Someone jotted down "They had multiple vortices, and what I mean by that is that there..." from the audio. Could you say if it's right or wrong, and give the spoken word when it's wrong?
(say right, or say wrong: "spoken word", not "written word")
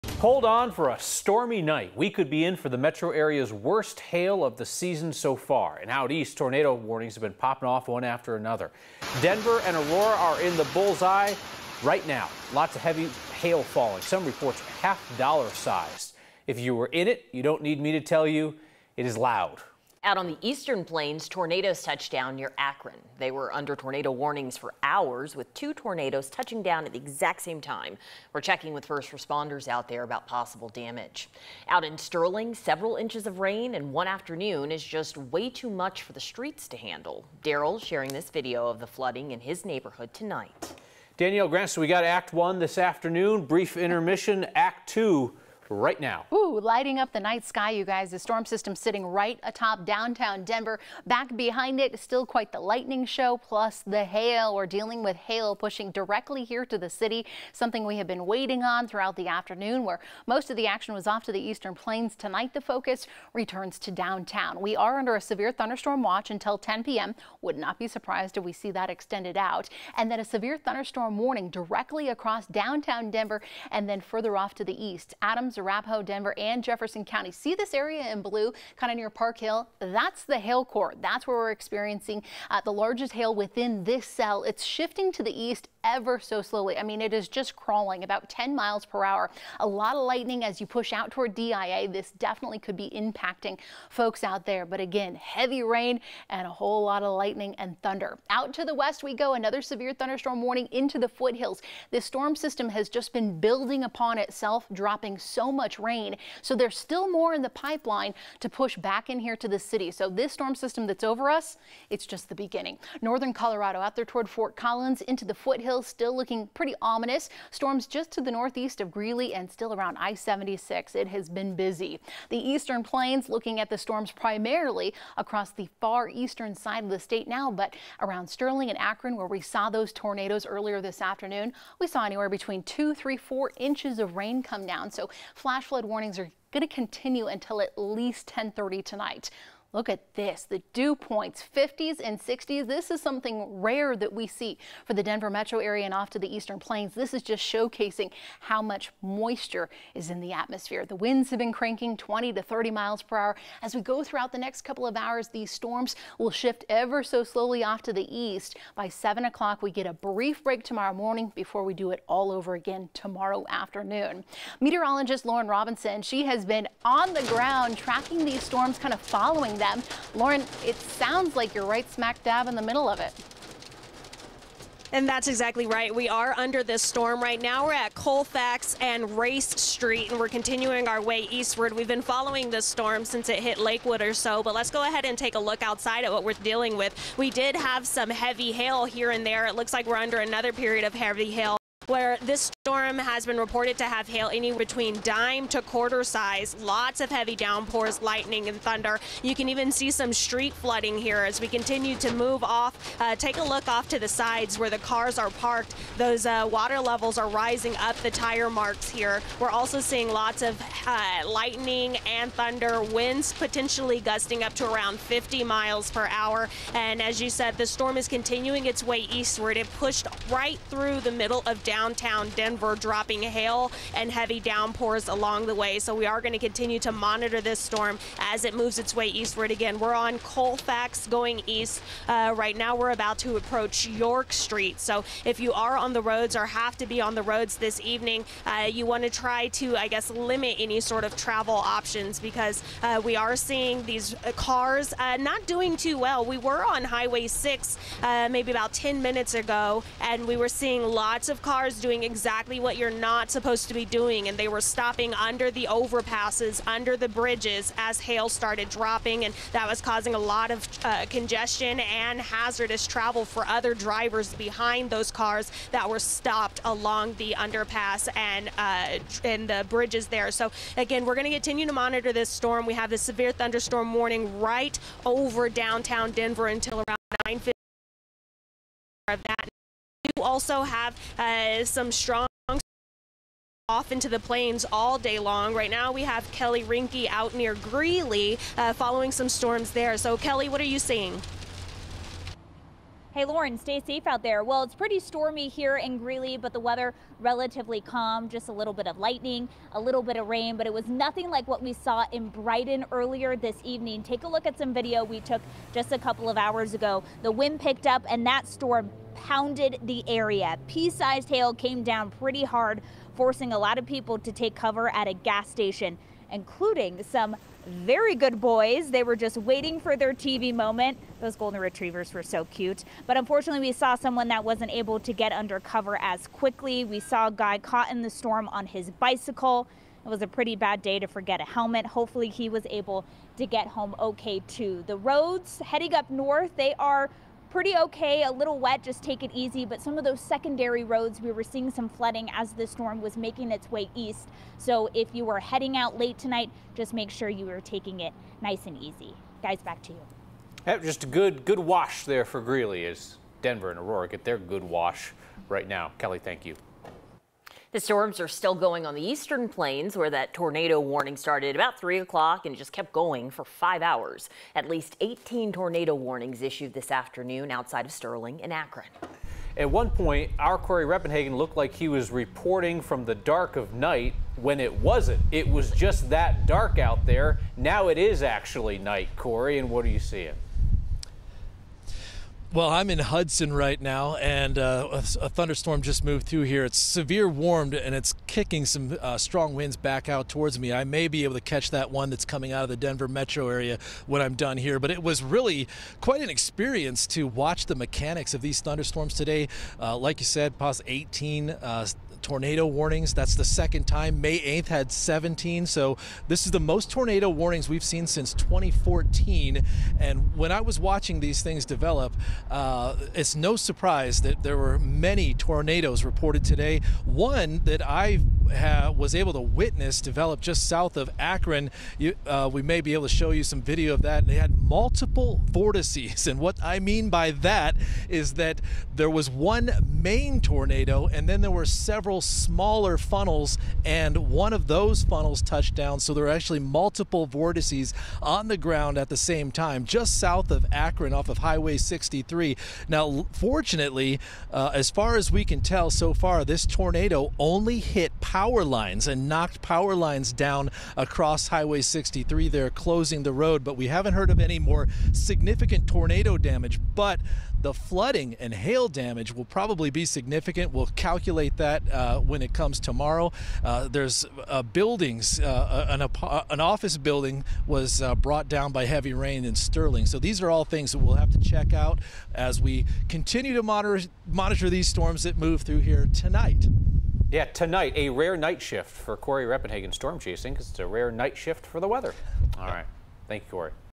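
right.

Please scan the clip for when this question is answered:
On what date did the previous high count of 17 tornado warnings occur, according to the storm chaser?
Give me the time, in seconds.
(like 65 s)
404 s.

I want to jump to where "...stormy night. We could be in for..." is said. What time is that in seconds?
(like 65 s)
0 s.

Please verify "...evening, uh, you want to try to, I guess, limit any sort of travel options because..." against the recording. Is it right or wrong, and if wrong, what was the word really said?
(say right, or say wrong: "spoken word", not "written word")
right.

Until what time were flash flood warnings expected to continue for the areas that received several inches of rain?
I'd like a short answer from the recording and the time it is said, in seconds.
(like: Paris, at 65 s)
10:30 tonight, at 138 s.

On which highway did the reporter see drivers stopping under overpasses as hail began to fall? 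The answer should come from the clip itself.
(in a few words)
Highway 6.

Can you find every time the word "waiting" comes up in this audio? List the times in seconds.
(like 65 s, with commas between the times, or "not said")
58 s, 319 s.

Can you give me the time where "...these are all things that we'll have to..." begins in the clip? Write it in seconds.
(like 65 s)
470 s.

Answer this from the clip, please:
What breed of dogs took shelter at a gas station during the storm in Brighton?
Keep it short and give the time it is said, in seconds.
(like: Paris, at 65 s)
Golden retrievers, at 321 s.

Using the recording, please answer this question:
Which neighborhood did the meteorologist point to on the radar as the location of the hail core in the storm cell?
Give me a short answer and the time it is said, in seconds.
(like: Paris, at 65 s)
Park Hill, at 79 s.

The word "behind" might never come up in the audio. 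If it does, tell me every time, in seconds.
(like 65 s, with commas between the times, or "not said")
51 s, 264 s.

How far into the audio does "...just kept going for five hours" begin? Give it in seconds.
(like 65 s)
362 s.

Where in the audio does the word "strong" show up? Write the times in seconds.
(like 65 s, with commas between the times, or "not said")
281 s, 389 s.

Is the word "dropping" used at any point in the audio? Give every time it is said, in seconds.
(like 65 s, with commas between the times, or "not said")
104 s, 222 s, 258 s.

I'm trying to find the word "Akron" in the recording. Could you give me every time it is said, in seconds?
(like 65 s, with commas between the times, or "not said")
22 s, 128 s, 368 s, 421 s, 440 s.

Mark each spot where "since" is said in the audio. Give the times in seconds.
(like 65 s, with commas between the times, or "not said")
183 s, 408 s.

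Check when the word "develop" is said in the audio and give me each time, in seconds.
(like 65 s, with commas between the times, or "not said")
411 s, 420 s.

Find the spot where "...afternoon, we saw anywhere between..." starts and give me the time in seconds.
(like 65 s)
131 s.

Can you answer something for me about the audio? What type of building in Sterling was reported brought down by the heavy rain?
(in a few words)
Office building.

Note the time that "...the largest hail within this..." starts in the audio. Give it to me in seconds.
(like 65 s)
82 s.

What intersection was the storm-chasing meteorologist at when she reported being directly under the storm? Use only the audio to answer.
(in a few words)
Colfax and Race Street.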